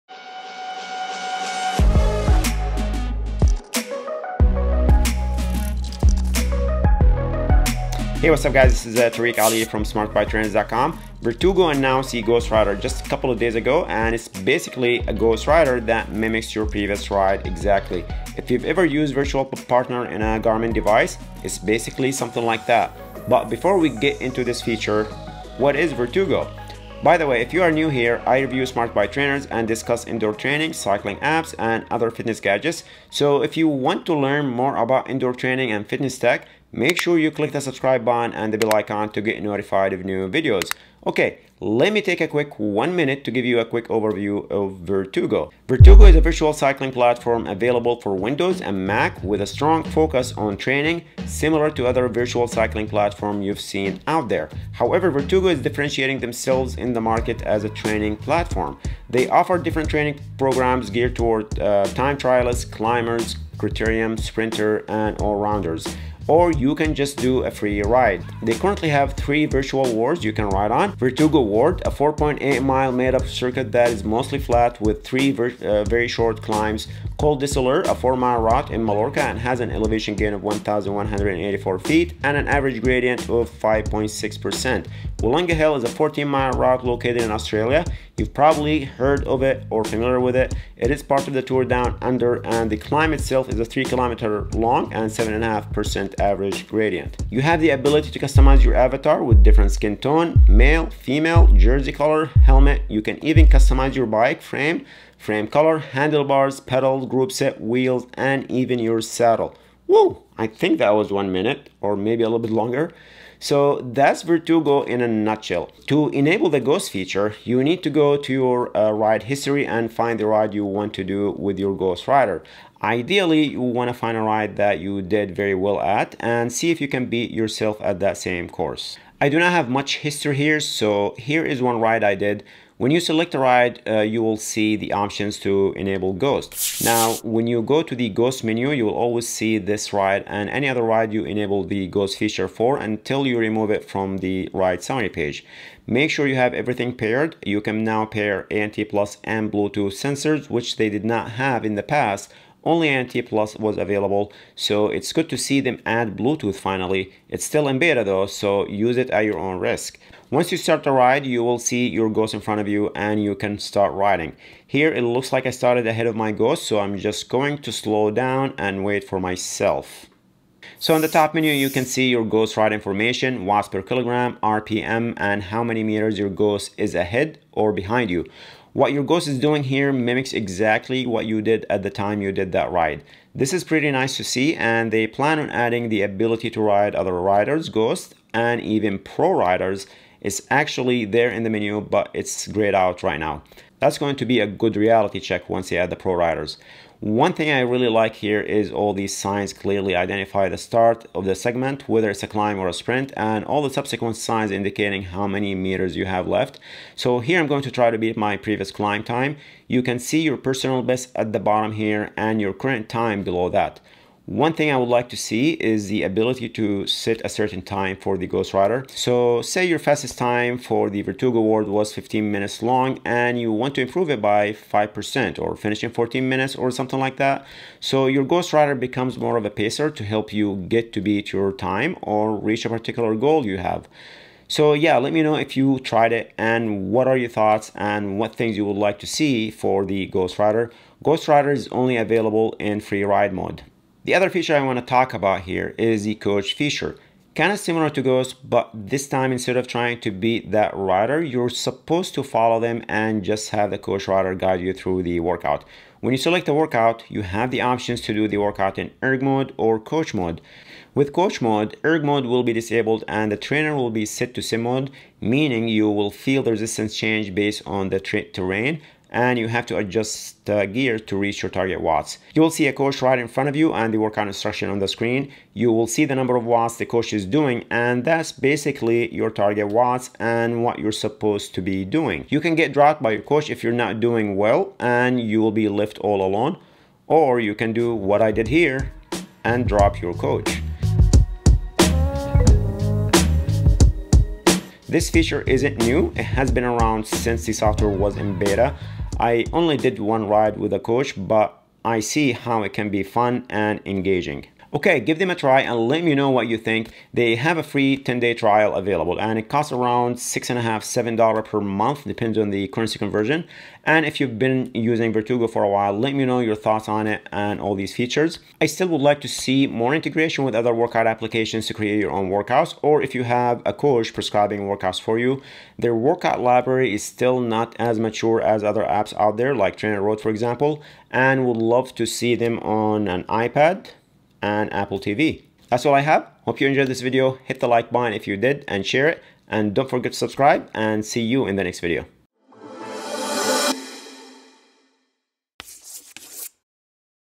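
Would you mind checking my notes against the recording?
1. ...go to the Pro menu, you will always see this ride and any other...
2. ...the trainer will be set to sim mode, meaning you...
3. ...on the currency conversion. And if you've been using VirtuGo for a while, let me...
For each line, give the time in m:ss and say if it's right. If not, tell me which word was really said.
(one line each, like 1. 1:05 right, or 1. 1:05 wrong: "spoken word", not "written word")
1. 2:17 wrong: "Ghost", not "Pro"
2. 4:23 right
3. 5:12 right.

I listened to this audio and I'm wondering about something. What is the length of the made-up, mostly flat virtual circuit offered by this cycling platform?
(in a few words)
4.8 miles.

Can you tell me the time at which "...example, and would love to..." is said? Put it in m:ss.
5:30.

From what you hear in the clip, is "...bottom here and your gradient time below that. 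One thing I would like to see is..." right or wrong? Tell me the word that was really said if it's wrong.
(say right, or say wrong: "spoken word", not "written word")
wrong: "current", not "gradient".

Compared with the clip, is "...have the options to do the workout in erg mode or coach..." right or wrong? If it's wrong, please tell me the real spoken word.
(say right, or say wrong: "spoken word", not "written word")
right.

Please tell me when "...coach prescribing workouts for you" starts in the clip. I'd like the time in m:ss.
5:23.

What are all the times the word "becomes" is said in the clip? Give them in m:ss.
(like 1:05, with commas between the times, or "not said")
3:48.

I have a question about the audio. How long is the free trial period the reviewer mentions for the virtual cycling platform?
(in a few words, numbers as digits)
10 days.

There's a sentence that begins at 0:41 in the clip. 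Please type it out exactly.
Okay, let me take a quick one minute to give you a quick overview of VirtuGo.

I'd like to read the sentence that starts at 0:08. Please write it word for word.
This is uh, Tariq Ali from smartbiketrainers.com.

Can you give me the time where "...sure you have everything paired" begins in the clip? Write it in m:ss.
2:26.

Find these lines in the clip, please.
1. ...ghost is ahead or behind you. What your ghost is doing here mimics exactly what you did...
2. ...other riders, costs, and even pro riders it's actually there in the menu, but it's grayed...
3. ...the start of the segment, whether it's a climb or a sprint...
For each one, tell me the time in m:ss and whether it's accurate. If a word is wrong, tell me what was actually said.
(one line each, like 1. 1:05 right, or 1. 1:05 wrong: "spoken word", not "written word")
1. 2:56 right
2. 3:06 wrong: "ghosts", not "costs"
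3. 3:20 right.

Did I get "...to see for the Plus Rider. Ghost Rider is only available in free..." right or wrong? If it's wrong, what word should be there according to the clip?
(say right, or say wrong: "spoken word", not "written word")
wrong: "Ghost", not "Plus".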